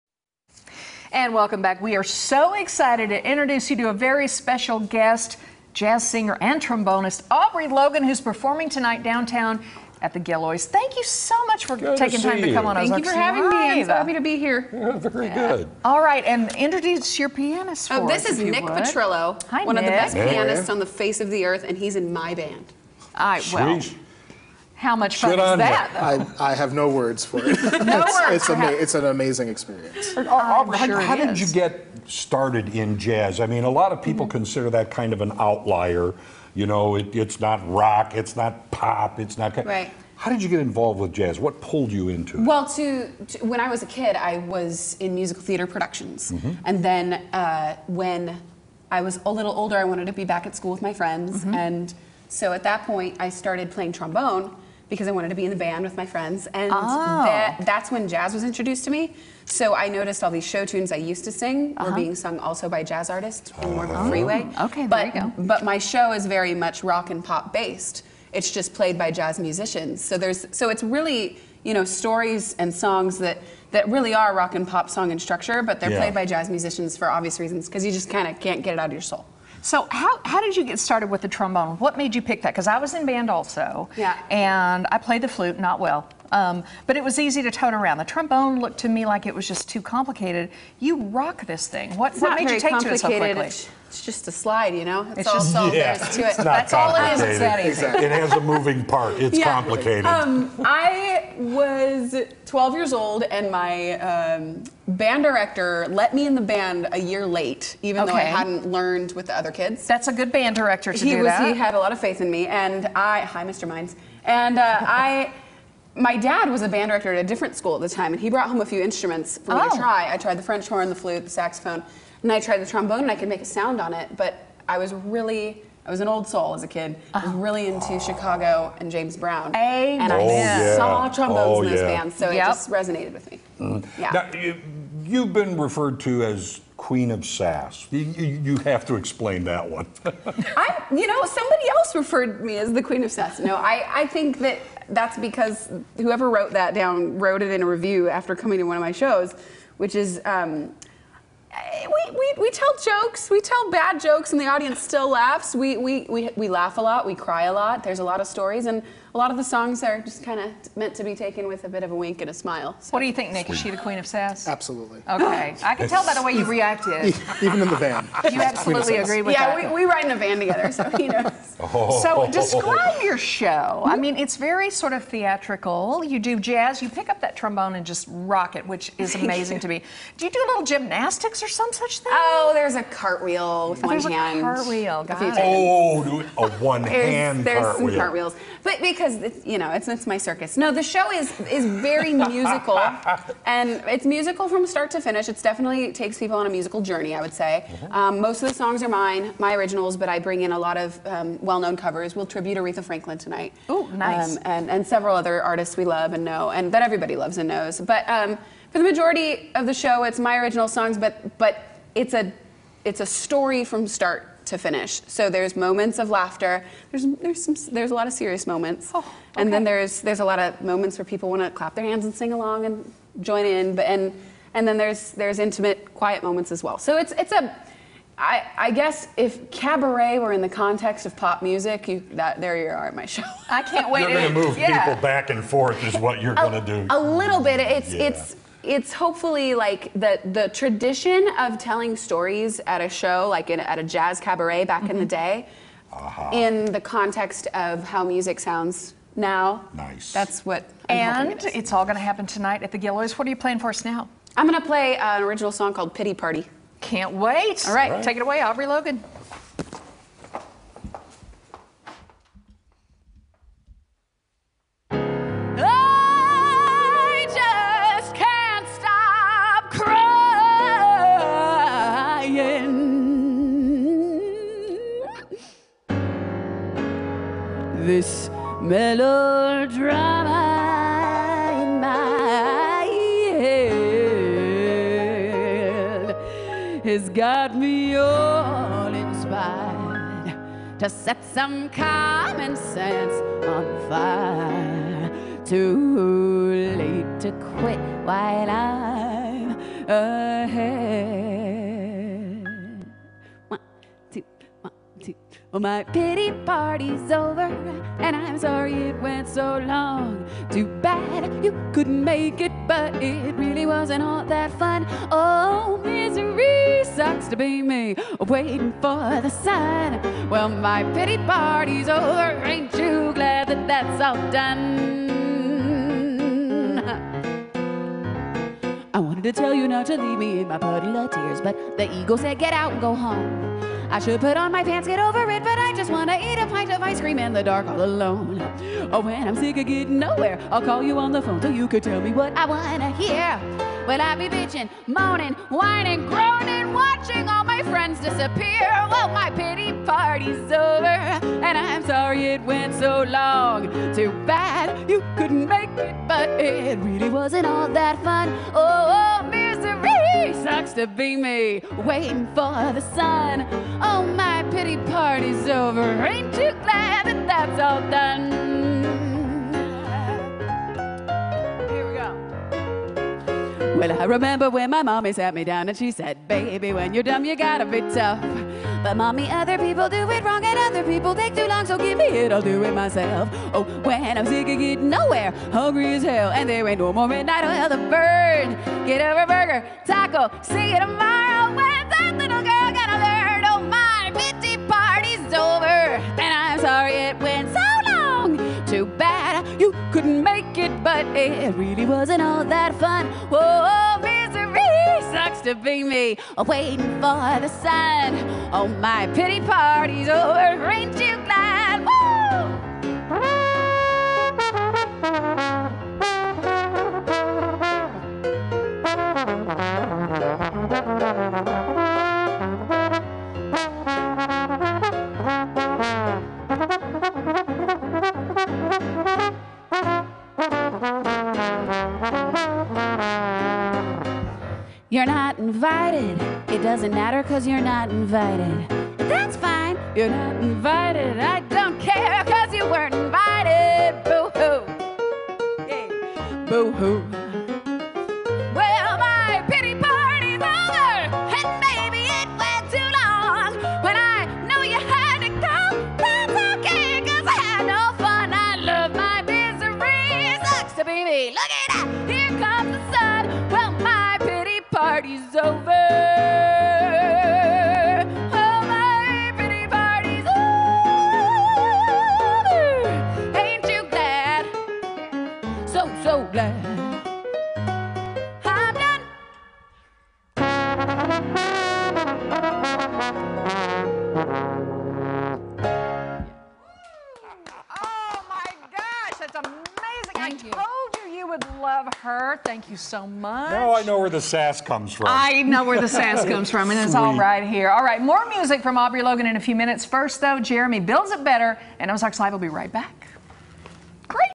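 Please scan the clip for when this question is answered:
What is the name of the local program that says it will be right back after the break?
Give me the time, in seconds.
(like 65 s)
501 s.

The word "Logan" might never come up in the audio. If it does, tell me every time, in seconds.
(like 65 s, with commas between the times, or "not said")
7 s, 258 s, 499 s.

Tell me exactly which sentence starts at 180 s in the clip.
Do you do a little gymnastics there some such thing?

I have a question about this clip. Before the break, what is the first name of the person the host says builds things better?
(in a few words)
Jeremy.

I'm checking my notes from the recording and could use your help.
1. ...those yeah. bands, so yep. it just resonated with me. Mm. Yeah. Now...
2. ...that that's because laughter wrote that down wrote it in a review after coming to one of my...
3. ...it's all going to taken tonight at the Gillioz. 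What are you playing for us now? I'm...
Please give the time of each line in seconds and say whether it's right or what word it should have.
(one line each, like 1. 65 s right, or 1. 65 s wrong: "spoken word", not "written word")
1. 131 s right
2. 144 s wrong: "whoever", not "laughter"
3. 251 s wrong: "happen", not "taken".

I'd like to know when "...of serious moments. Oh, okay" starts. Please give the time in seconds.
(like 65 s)
218 s.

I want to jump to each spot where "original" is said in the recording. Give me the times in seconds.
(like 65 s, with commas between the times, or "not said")
199 s, 210 s, 255 s.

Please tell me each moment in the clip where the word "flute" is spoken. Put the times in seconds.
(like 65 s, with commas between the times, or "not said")
85 s, 120 s.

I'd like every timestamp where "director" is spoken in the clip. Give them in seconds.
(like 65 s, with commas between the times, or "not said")
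105 s, 110 s, 116 s.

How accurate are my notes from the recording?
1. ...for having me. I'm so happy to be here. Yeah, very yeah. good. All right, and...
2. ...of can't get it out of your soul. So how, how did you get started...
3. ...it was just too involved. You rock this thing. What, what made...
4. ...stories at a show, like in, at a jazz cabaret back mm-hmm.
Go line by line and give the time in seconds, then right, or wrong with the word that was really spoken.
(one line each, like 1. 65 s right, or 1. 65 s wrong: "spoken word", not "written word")
1. 13 s right
2. 78 s right
3. 89 s wrong: "complicated", not "involved"
4. 241 s right.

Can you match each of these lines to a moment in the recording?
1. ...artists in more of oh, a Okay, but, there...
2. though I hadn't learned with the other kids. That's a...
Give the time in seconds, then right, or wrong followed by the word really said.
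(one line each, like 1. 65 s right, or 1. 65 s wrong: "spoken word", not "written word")
1. 63 s right
2. 108 s right.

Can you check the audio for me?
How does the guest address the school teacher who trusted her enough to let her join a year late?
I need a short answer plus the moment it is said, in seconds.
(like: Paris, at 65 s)
Mr. Mines, at 113 s.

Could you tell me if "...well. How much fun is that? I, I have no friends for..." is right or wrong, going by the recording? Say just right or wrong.
wrong.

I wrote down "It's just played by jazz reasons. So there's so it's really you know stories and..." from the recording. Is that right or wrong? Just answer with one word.
wrong.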